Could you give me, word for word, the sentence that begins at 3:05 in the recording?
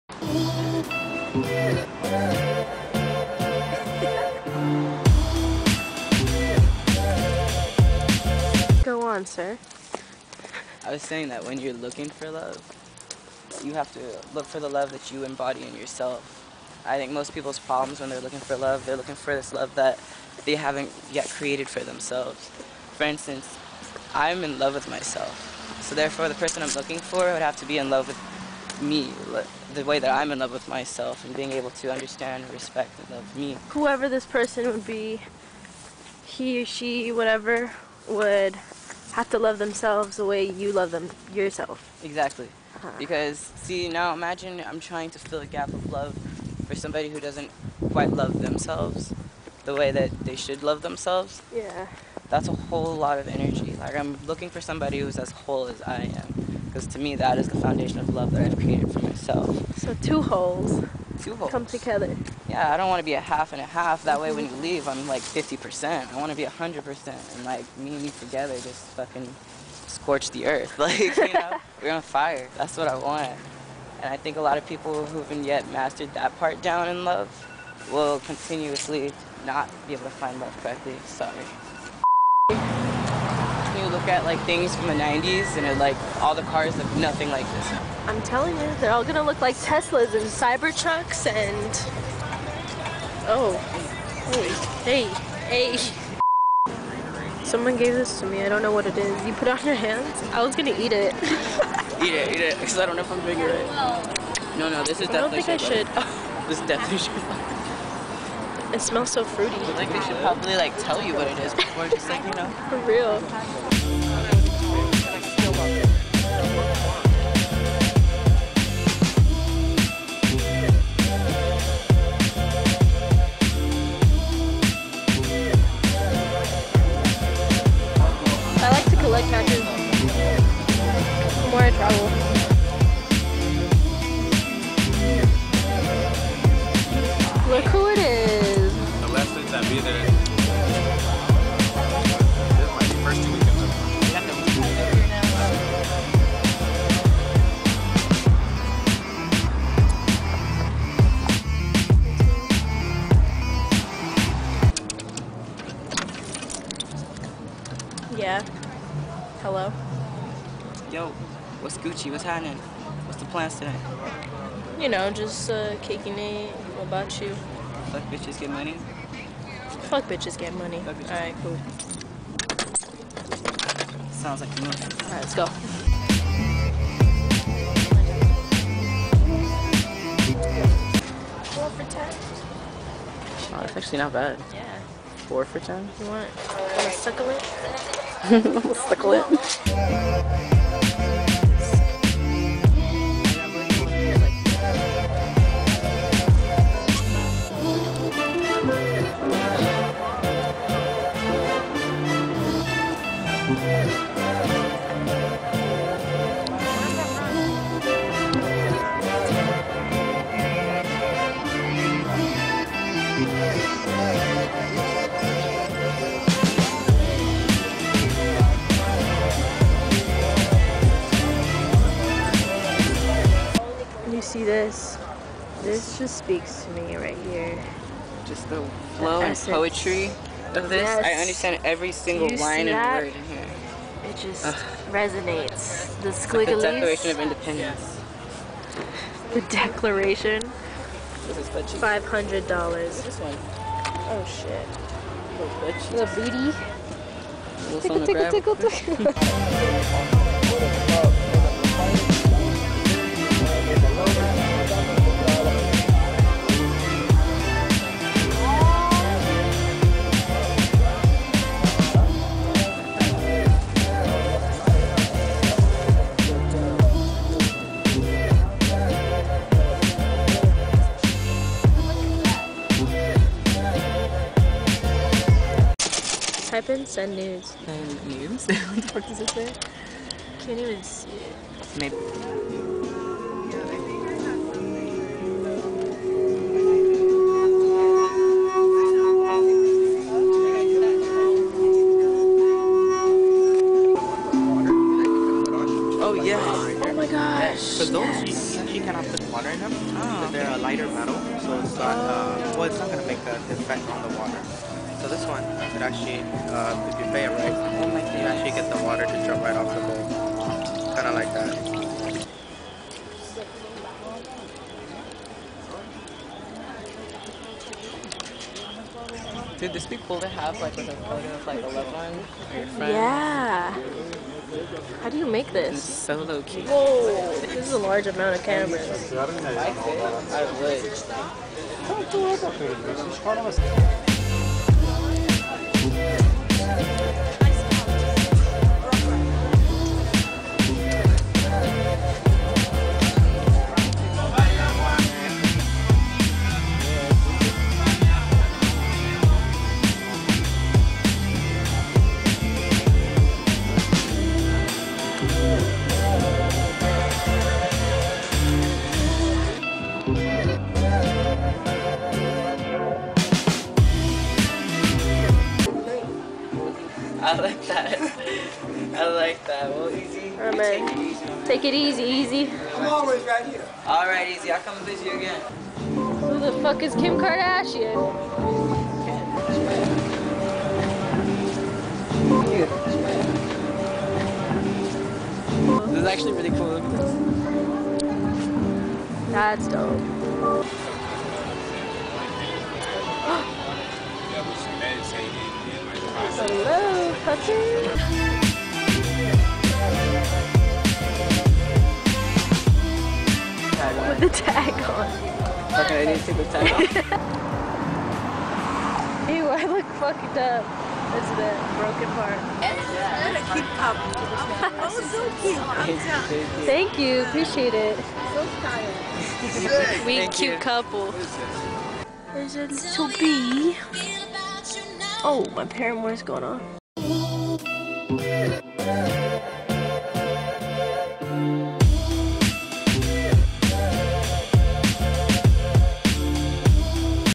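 You want, want a suckle it?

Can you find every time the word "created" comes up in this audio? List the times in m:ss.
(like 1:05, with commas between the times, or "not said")
0:21, 0:58.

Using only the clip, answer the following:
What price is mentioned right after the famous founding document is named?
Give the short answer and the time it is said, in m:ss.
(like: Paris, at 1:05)
$500, at 4:01.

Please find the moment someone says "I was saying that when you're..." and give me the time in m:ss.
0:10.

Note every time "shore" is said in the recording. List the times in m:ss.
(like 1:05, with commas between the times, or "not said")
not said.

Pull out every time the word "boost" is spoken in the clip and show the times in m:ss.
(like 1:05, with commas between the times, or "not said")
not said.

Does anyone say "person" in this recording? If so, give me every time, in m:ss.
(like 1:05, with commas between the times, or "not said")
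0:26, 0:34.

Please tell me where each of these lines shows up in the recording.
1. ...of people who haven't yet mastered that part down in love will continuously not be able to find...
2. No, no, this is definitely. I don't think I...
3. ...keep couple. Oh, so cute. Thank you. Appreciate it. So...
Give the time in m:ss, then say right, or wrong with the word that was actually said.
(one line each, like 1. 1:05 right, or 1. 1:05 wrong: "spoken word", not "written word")
1. 1:14 right
2. 1:44 right
3. 6:53 right.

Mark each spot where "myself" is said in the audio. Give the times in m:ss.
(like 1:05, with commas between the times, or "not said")
0:24, 0:30, 0:58.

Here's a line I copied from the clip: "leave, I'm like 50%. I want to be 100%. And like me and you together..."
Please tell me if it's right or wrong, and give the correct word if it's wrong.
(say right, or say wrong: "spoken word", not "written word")
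right.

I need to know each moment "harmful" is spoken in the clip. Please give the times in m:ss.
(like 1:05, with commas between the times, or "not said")
not said.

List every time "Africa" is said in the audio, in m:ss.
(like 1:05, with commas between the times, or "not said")
not said.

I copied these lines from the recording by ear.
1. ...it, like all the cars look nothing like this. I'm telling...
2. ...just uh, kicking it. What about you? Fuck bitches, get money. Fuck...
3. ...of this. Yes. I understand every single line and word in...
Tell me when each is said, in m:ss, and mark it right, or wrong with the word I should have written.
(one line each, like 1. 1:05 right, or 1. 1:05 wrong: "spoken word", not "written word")
1. 1:25 right
2. 2:45 right
3. 3:50 right.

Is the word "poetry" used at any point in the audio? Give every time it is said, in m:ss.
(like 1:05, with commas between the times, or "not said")
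3:49.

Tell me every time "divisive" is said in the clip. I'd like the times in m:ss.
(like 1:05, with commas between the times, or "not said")
not said.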